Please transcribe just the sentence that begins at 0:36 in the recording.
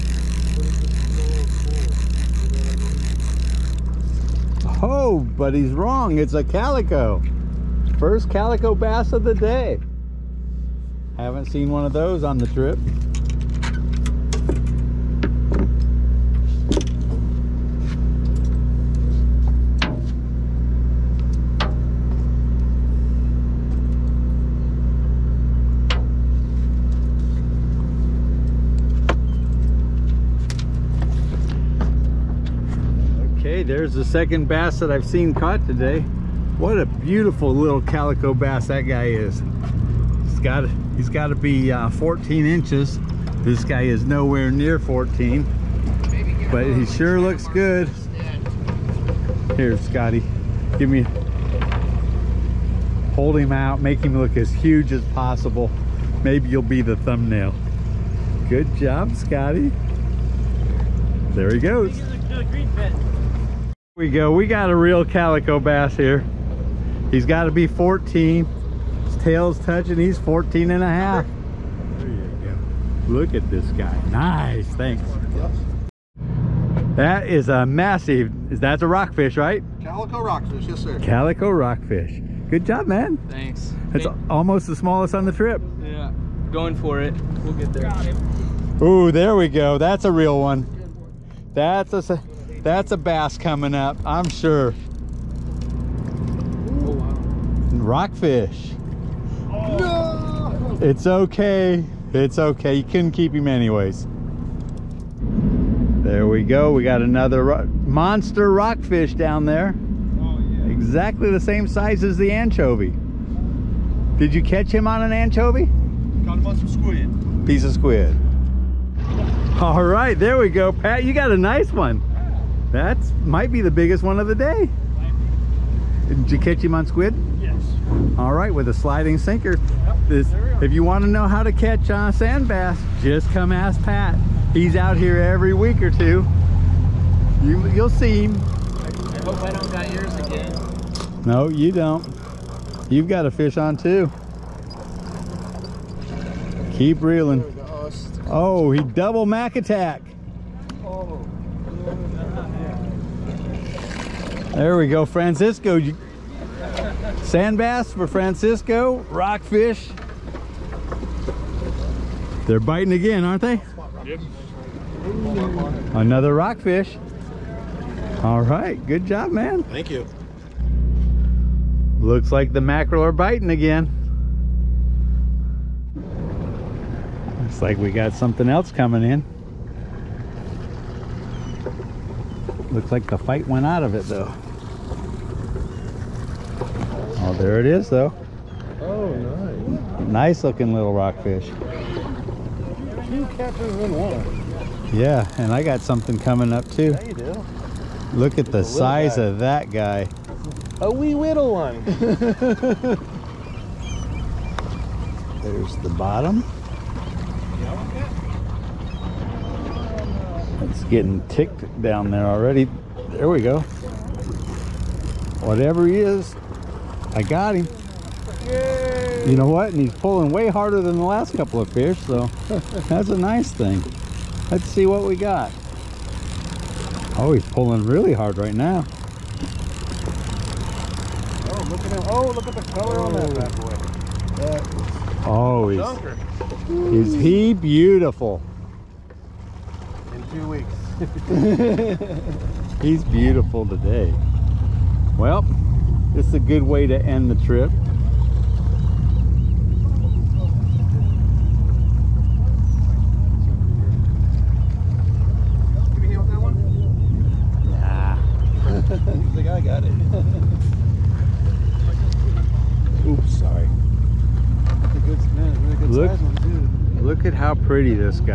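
What a beautiful little calico bass that guy is.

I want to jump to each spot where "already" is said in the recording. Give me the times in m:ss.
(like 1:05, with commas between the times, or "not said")
3:32.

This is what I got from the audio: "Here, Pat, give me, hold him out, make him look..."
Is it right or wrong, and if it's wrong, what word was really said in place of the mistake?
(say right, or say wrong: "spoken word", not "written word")
wrong: "Scotty", not "Pat".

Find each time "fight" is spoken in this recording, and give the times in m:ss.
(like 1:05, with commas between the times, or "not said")
3:03.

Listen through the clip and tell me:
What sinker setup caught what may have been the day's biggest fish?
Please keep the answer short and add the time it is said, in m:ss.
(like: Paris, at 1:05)
sliding sinker, at 2:08.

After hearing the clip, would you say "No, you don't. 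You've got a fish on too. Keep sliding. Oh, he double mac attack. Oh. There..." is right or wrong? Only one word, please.
wrong.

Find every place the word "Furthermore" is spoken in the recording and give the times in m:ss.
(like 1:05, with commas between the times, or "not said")
not said.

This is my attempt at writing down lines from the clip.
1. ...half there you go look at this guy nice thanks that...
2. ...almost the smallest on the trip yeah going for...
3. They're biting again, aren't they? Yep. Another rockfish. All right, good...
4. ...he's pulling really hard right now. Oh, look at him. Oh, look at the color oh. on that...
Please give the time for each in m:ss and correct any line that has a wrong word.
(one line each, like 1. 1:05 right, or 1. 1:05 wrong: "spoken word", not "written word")
1. 1:10 right
2. 1:24 right
3. 2:42 right
4. 3:47 right.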